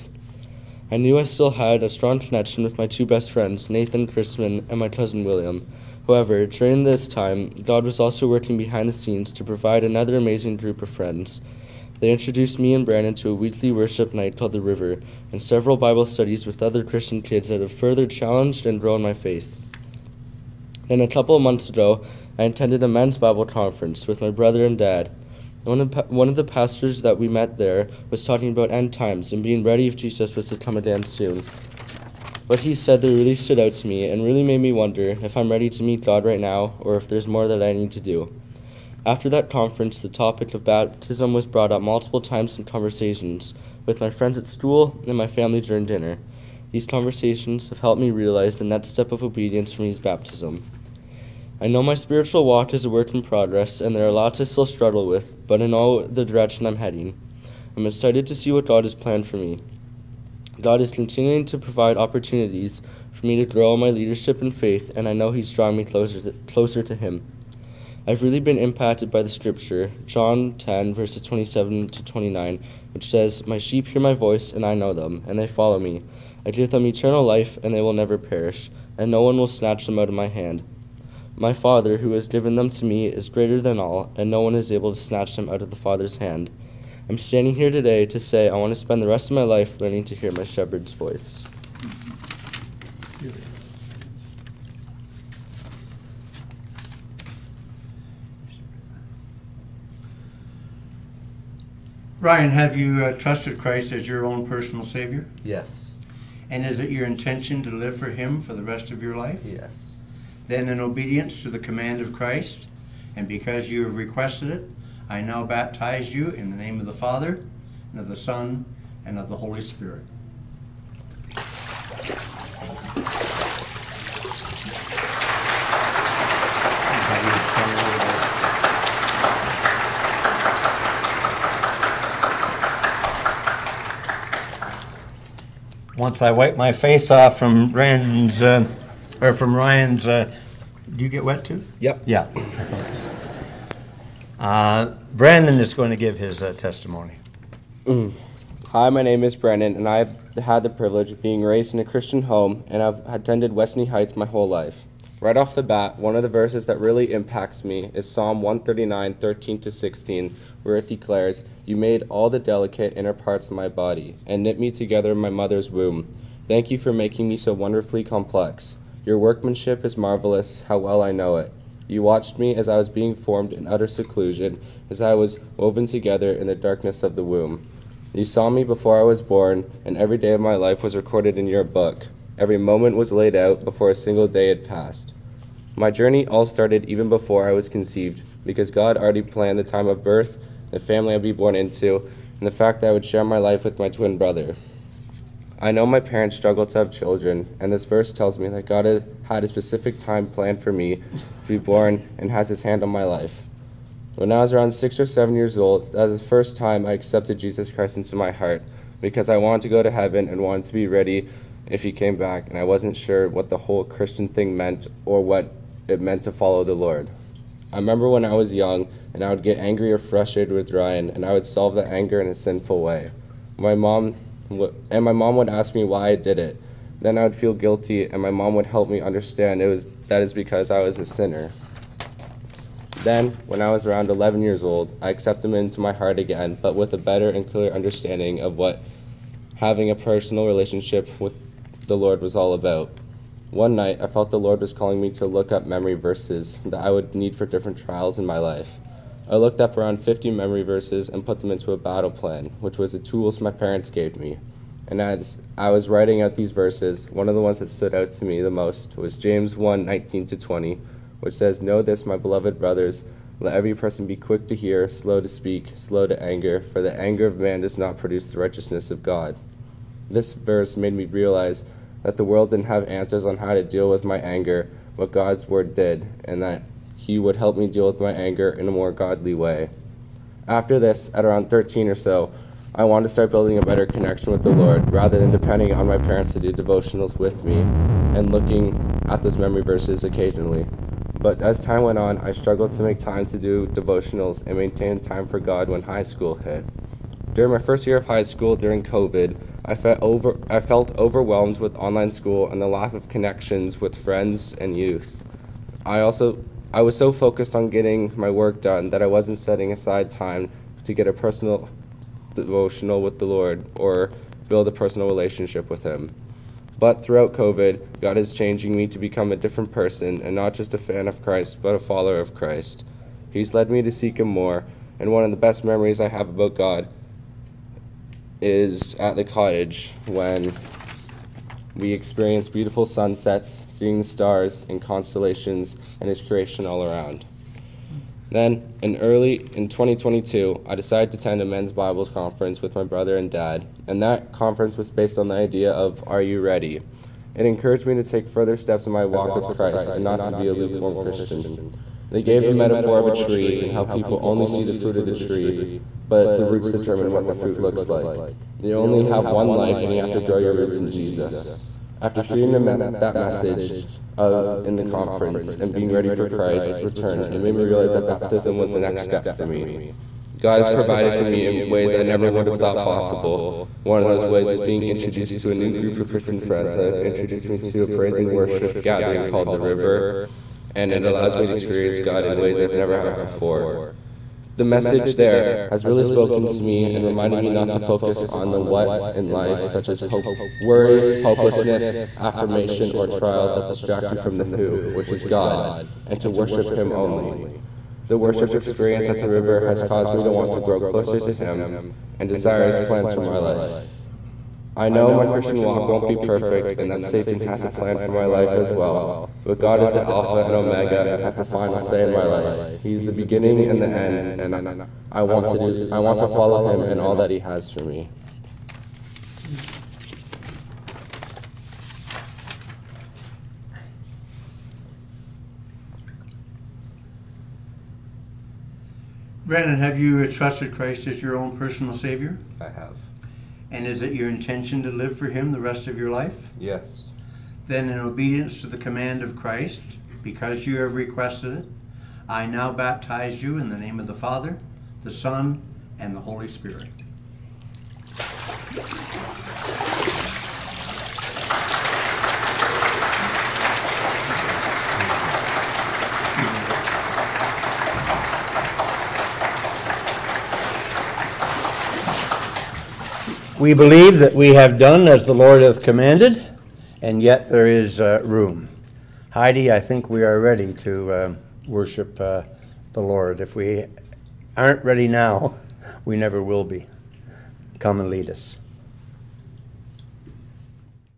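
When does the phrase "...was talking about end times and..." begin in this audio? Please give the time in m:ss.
0:28.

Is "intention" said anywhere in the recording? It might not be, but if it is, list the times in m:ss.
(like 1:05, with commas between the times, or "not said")
1:47, 7:14.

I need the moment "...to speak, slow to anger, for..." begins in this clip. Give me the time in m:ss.
4:25.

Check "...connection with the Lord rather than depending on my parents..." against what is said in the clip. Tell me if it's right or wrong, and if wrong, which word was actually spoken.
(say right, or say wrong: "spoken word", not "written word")
right.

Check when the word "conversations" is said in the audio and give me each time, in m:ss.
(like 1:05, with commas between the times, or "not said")
0:42, 0:46.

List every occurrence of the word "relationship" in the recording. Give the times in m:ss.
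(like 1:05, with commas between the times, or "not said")
4:00, 5:15.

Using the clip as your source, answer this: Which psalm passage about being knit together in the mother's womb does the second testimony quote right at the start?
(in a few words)
Psalm 139:13-16.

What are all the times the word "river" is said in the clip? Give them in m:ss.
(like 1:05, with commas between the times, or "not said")
0:14, 6:19, 6:39.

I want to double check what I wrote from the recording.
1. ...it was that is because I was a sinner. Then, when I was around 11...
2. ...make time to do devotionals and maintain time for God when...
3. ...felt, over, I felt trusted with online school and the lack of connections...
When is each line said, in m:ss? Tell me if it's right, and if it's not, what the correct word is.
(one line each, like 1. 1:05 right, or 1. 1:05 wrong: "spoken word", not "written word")
1. 3:49 right
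2. 4:52 right
3. 4:59 wrong: "overwhelmed", not "trusted".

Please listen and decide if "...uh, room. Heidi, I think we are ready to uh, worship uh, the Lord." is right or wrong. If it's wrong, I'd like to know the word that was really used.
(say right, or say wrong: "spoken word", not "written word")
right.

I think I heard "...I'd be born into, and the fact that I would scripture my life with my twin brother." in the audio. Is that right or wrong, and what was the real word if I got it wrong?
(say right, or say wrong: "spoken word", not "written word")
wrong: "share", not "scripture".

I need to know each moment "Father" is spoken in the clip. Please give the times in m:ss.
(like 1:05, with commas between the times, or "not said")
1:21, 1:25, 1:56, 7:24.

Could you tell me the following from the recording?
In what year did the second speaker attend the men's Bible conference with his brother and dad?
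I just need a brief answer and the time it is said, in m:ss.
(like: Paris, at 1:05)
2022, at 5:39.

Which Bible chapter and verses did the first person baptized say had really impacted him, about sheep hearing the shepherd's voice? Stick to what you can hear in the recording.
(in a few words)
John 10:27-29.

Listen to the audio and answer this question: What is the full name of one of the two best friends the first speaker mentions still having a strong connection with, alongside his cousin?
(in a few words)
Nathan Christman.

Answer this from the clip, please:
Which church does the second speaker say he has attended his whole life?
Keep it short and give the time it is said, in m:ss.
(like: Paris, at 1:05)
Westney Heights, at 2:33.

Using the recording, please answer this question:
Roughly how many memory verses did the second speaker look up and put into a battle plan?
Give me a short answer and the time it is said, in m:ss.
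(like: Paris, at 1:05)
50, at 4:09.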